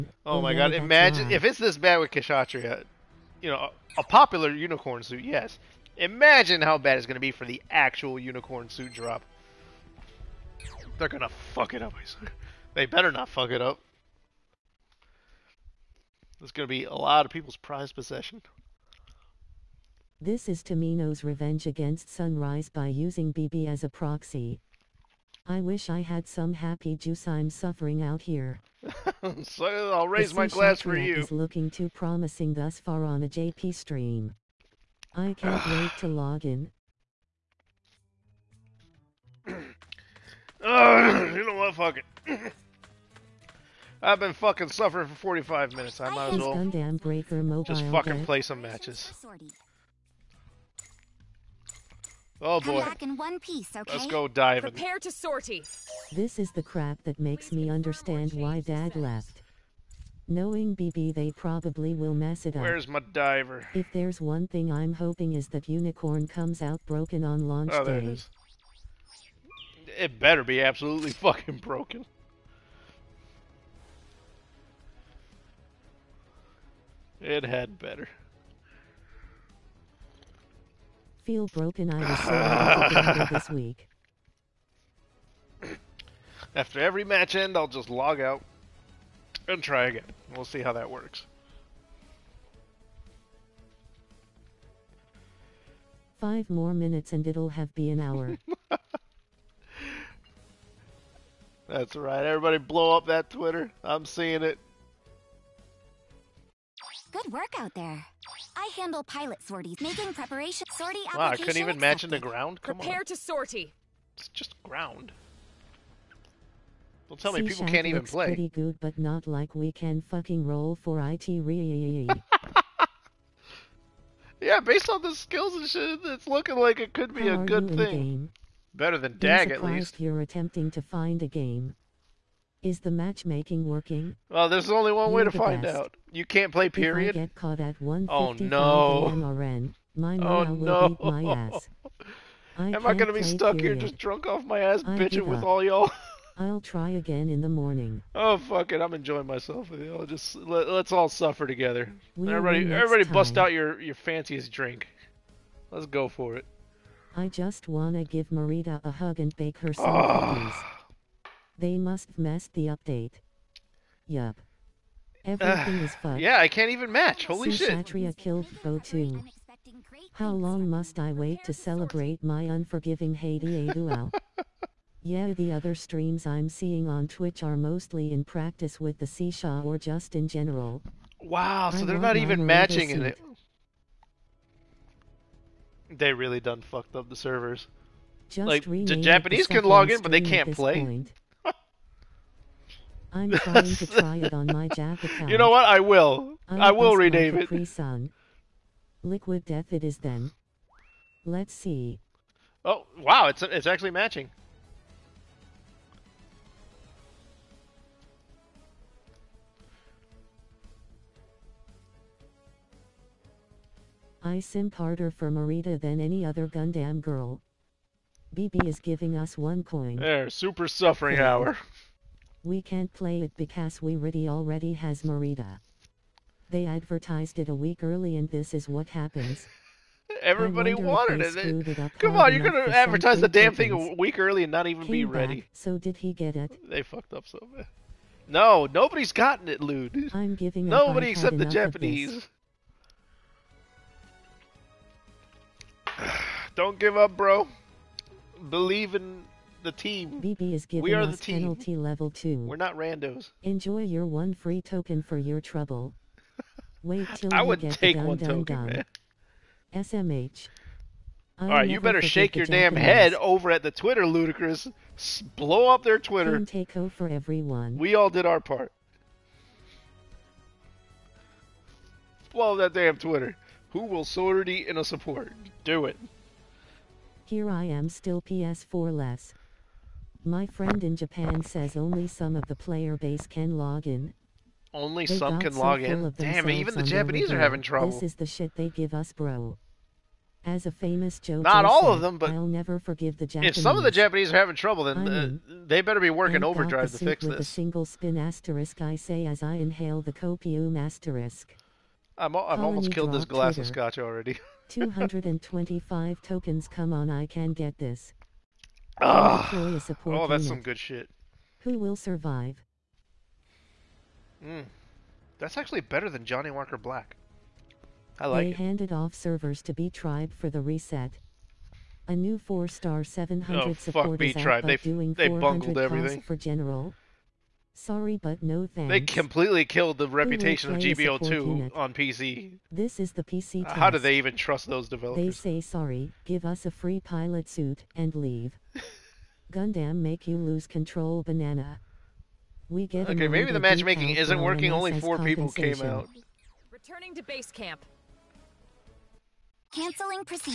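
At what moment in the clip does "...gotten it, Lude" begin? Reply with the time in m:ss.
3:59.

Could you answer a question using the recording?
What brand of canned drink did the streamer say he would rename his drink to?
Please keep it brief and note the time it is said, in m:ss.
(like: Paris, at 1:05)
Liquid Death, at 3:19.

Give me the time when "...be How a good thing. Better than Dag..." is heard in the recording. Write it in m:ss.
2:07.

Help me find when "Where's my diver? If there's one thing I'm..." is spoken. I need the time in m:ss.
1:02.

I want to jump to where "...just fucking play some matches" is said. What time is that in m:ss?
0:47.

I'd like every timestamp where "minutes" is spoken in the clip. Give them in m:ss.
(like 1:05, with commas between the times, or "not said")
0:45, 1:36.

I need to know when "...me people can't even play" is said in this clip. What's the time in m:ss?
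1:57.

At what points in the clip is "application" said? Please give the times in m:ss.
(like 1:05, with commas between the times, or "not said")
1:51.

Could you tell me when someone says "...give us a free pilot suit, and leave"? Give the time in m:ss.
5:36.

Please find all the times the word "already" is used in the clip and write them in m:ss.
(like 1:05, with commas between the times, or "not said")
3:44, 5:03.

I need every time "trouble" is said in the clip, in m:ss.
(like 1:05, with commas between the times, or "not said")
4:15, 4:47, 4:54.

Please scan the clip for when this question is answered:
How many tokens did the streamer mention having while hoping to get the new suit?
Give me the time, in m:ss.
5:04.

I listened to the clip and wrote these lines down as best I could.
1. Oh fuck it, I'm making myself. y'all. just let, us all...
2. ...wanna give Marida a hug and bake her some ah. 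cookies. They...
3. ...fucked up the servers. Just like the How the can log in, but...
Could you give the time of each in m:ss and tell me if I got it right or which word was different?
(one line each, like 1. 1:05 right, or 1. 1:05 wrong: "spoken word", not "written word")
1. 2:28 wrong: "enjoying", not "making"
2. 2:37 right
3. 3:06 wrong: "Japanese", not "How".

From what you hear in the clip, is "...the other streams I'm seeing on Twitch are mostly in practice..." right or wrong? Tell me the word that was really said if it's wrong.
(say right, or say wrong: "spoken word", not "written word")
right.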